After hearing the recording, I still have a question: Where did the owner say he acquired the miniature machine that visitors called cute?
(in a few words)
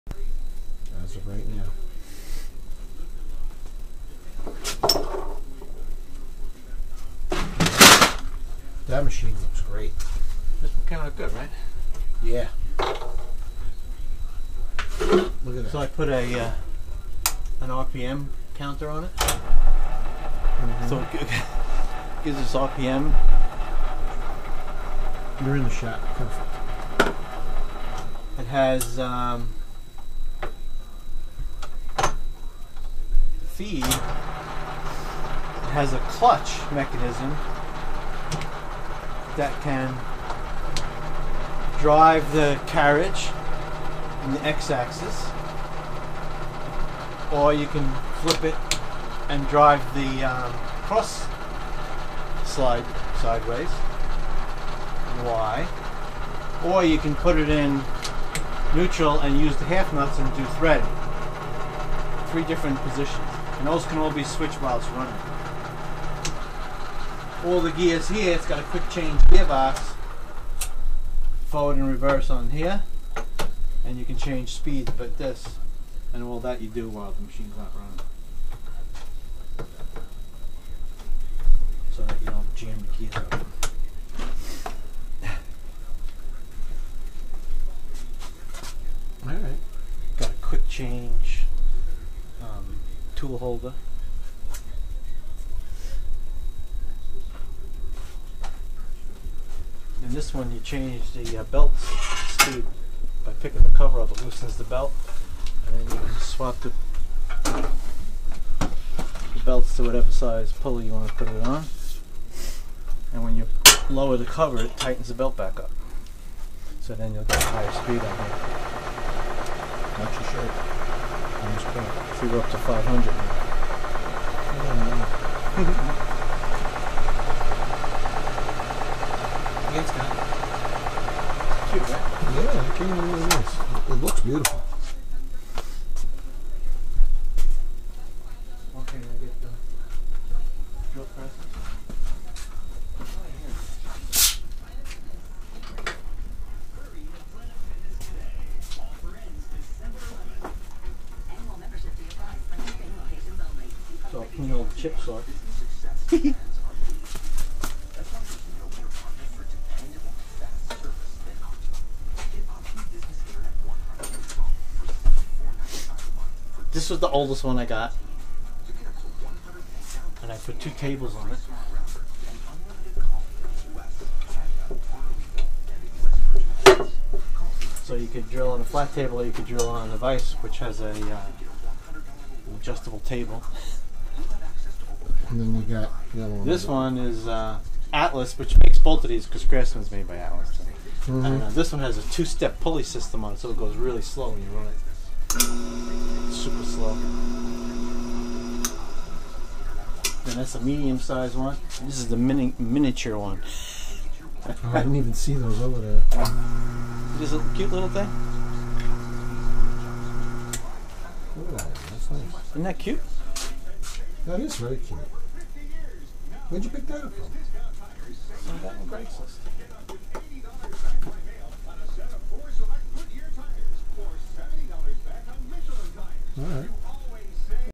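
Craigslist.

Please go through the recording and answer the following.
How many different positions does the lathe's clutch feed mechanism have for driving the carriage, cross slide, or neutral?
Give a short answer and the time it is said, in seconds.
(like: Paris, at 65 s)
3, at 62 s.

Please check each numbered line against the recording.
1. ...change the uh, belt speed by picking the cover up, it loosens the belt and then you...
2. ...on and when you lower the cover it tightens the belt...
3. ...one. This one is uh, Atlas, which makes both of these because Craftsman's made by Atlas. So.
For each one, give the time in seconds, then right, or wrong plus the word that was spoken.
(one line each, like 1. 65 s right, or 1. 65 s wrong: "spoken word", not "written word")
1. 100 s right
2. 111 s right
3. 186 s right.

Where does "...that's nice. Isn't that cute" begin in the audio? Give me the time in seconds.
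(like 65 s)
211 s.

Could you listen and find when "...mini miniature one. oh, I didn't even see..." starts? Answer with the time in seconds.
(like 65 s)
202 s.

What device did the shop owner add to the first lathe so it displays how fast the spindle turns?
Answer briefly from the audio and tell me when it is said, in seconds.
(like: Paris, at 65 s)
RPM counter, at 17 s.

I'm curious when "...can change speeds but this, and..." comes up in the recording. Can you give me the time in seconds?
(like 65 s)
74 s.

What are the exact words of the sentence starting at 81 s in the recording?
So that you don't jam the gears up.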